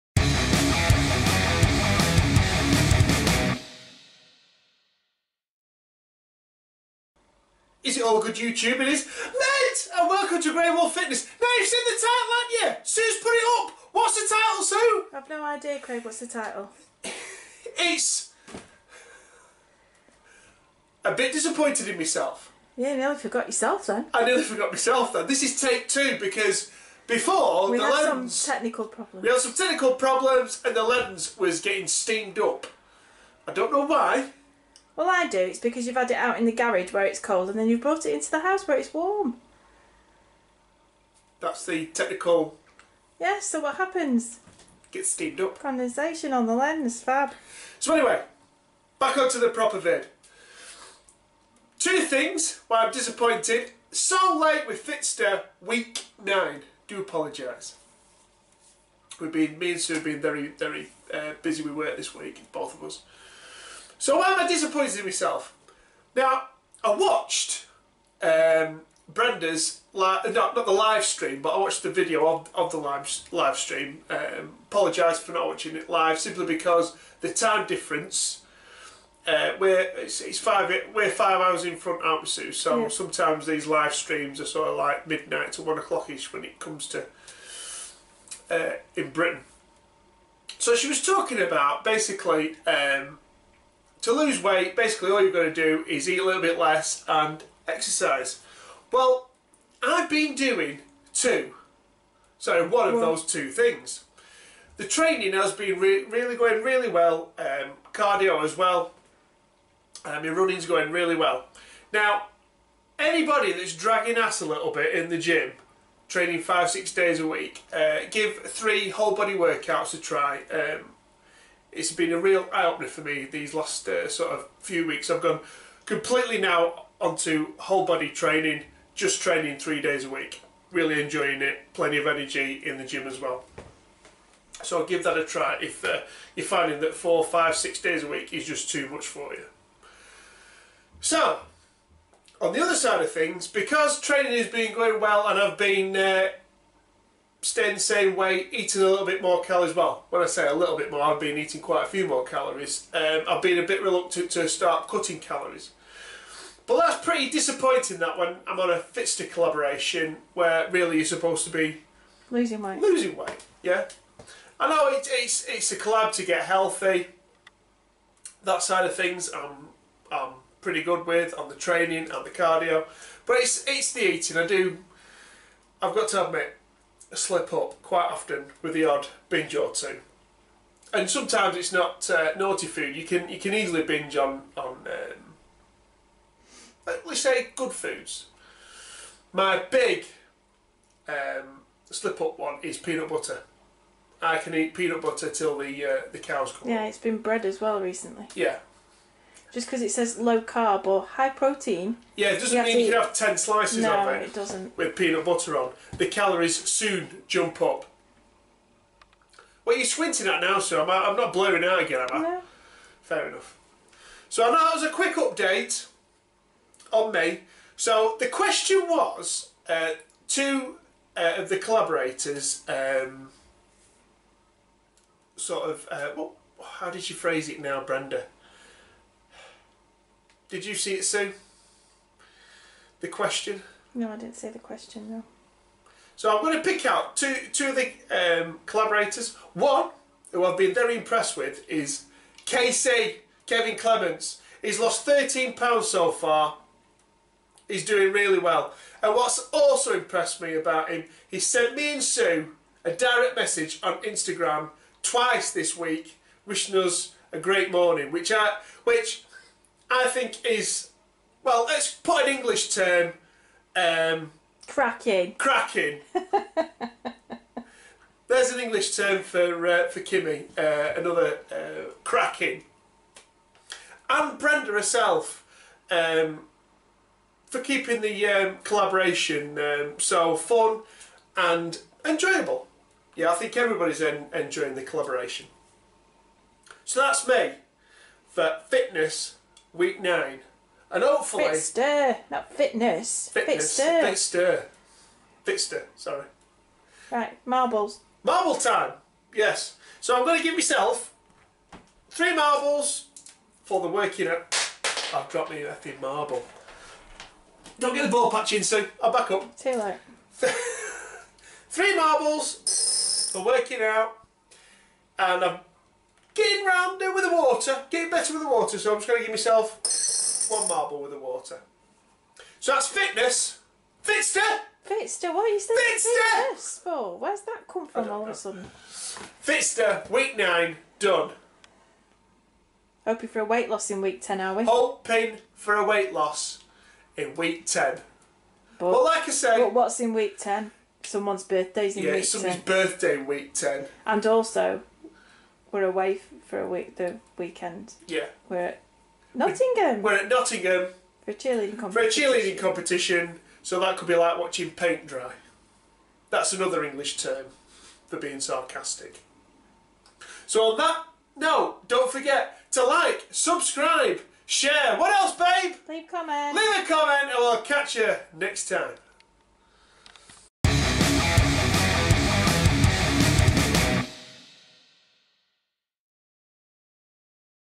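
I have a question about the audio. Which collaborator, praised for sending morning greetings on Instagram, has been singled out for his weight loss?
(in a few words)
Kevin Clements.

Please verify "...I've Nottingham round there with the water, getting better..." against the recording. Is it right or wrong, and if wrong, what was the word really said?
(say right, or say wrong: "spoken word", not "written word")
wrong: "Getting", not "Nottingham".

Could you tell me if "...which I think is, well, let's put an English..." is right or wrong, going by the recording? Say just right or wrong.
right.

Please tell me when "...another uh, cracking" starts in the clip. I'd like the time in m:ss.
4:30.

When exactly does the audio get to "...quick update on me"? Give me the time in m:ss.
3:34.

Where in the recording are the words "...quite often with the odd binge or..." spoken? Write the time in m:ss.
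2:57.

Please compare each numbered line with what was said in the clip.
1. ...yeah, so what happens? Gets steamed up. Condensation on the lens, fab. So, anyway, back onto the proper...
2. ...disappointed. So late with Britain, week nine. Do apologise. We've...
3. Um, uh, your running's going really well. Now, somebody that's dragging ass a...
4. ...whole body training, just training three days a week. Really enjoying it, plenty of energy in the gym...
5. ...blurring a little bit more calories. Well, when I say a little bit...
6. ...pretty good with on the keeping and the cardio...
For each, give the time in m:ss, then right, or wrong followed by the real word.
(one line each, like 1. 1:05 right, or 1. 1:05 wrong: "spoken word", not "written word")
1. 0:43 right
2. 0:52 wrong: "Fitster", not "Britain"
3. 1:50 wrong: "anybody", not "somebody"
4. 2:07 right
5. 2:28 wrong: "eating", not "blurring"
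6. 2:50 wrong: "training", not "keeping".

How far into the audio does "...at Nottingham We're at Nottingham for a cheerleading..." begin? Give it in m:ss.
5:48.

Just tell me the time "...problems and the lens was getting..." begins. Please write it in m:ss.
0:29.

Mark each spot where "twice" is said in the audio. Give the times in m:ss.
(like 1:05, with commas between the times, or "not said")
4:15.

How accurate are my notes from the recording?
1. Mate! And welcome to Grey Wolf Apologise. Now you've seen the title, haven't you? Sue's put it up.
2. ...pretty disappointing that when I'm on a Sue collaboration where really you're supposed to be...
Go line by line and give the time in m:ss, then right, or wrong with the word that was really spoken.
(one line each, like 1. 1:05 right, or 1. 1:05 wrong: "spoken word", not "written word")
1. 0:09 wrong: "Fitness", not "Apologise"
2. 2:37 wrong: "Fitster", not "Sue".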